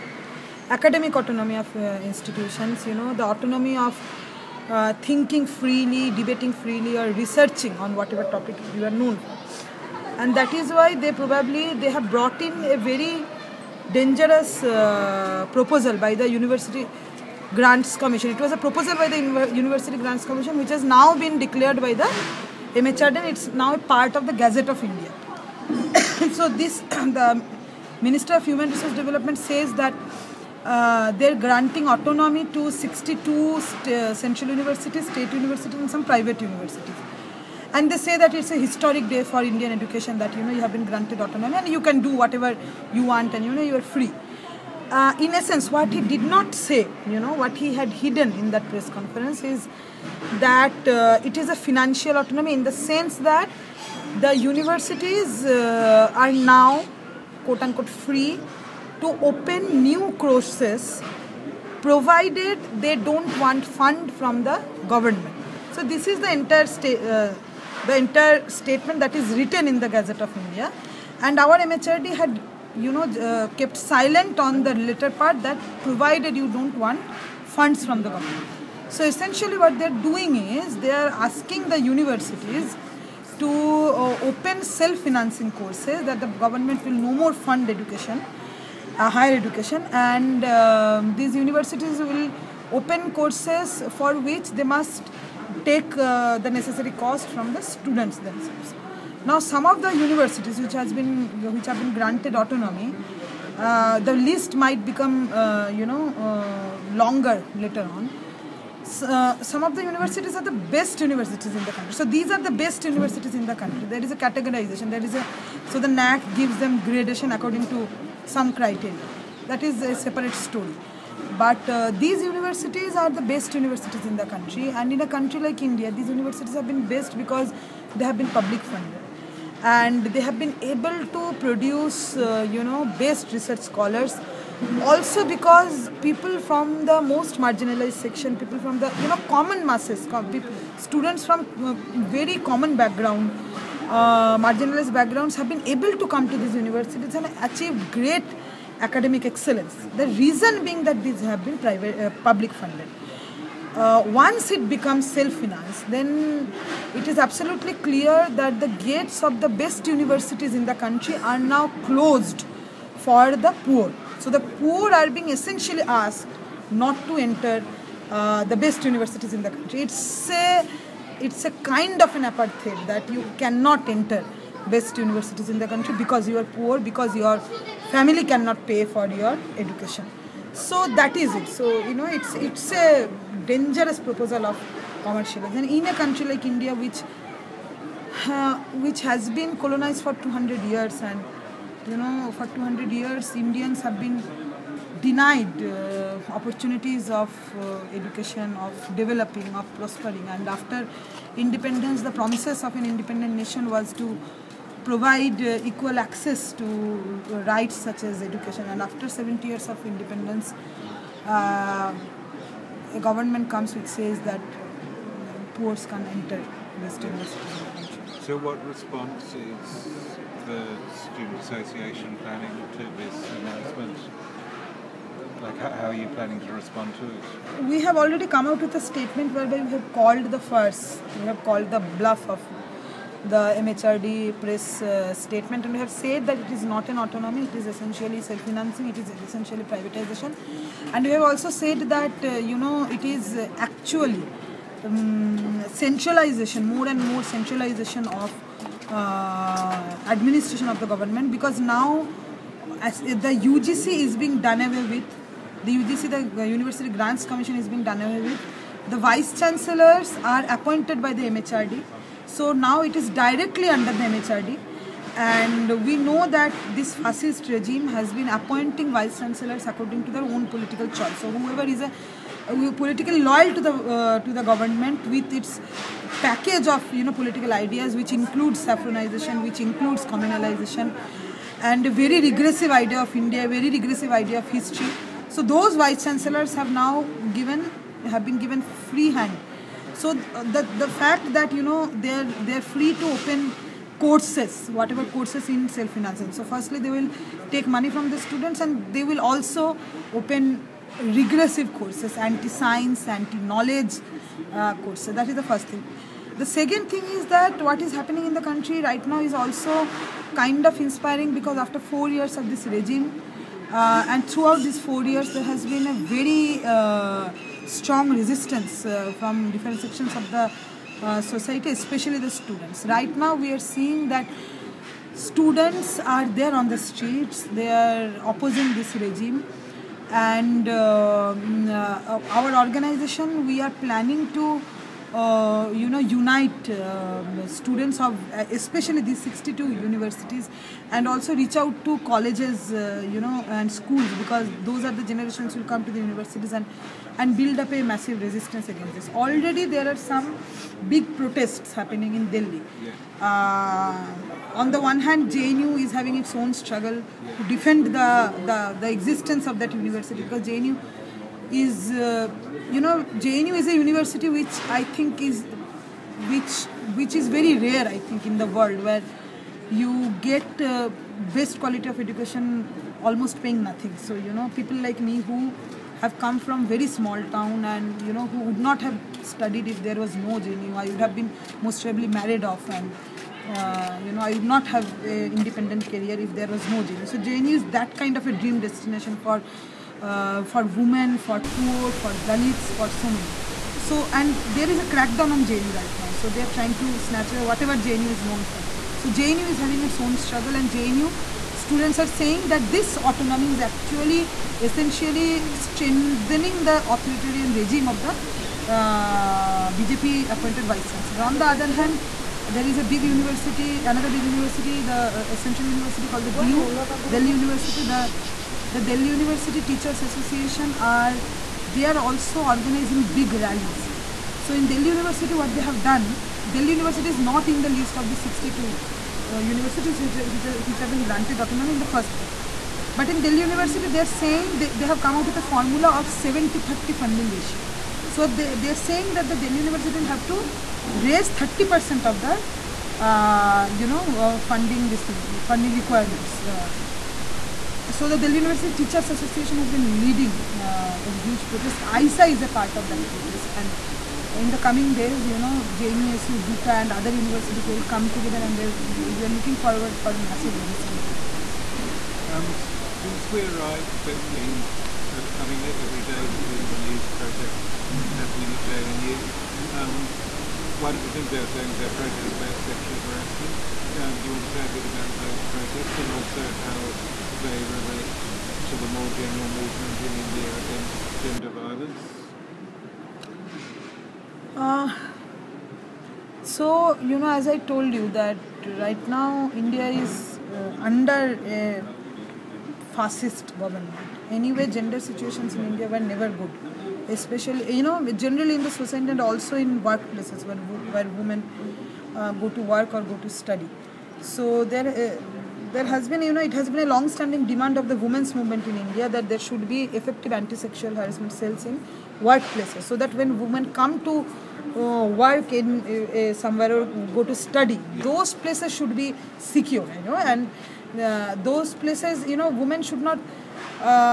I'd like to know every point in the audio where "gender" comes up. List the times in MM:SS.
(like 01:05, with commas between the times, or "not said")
08:01, 08:14.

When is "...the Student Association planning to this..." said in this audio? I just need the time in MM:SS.
03:40.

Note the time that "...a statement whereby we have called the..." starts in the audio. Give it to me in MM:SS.
03:48.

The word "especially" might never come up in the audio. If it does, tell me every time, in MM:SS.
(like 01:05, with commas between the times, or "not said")
05:21, 05:38, 08:17.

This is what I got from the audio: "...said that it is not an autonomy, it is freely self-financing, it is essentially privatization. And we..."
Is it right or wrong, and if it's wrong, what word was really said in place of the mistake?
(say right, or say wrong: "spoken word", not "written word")
wrong: "essentially", not "freely".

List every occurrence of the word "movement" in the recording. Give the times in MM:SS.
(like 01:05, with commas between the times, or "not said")
07:59, 08:28.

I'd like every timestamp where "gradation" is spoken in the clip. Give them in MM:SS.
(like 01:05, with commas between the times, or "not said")
01:56.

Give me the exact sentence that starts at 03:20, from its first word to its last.
And after independence, the promises of an independent nation was to provide uh, equal access to uh, rights such as education.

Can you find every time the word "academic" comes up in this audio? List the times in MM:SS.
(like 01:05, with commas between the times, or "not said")
00:00, 02:28.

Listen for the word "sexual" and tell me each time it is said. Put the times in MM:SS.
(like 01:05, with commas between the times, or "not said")
07:52, 08:30.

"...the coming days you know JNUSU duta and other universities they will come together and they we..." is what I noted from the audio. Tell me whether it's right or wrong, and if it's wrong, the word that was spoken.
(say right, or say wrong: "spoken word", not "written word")
right.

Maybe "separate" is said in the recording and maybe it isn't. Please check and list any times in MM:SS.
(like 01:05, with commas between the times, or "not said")
01:59.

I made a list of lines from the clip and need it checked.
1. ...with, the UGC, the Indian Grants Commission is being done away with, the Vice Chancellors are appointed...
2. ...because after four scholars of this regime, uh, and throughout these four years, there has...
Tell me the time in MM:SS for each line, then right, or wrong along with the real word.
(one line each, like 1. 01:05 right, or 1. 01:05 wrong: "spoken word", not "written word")
1. 04:14 wrong: "University", not "Indian"
2. 05:11 wrong: "years", not "scholars".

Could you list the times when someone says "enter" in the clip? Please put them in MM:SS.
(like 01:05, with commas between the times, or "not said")
02:47, 02:53, 03:36.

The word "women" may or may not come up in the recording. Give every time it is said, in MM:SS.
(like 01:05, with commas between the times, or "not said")
06:30, 08:21, 08:28, 08:33, 08:42.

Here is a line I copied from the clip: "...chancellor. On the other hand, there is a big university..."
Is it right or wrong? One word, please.
right.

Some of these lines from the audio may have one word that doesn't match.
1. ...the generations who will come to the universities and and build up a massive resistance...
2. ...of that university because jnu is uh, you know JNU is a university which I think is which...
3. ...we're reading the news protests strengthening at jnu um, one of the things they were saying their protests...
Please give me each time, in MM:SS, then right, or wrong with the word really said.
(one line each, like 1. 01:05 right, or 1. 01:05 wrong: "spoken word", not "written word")
1. 05:44 right
2. 05:59 right
3. 07:46 wrong: "happening", not "strengthening".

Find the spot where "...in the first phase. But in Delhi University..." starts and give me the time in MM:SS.
07:11.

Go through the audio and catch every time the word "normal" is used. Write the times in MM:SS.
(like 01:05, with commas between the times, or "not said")
not said.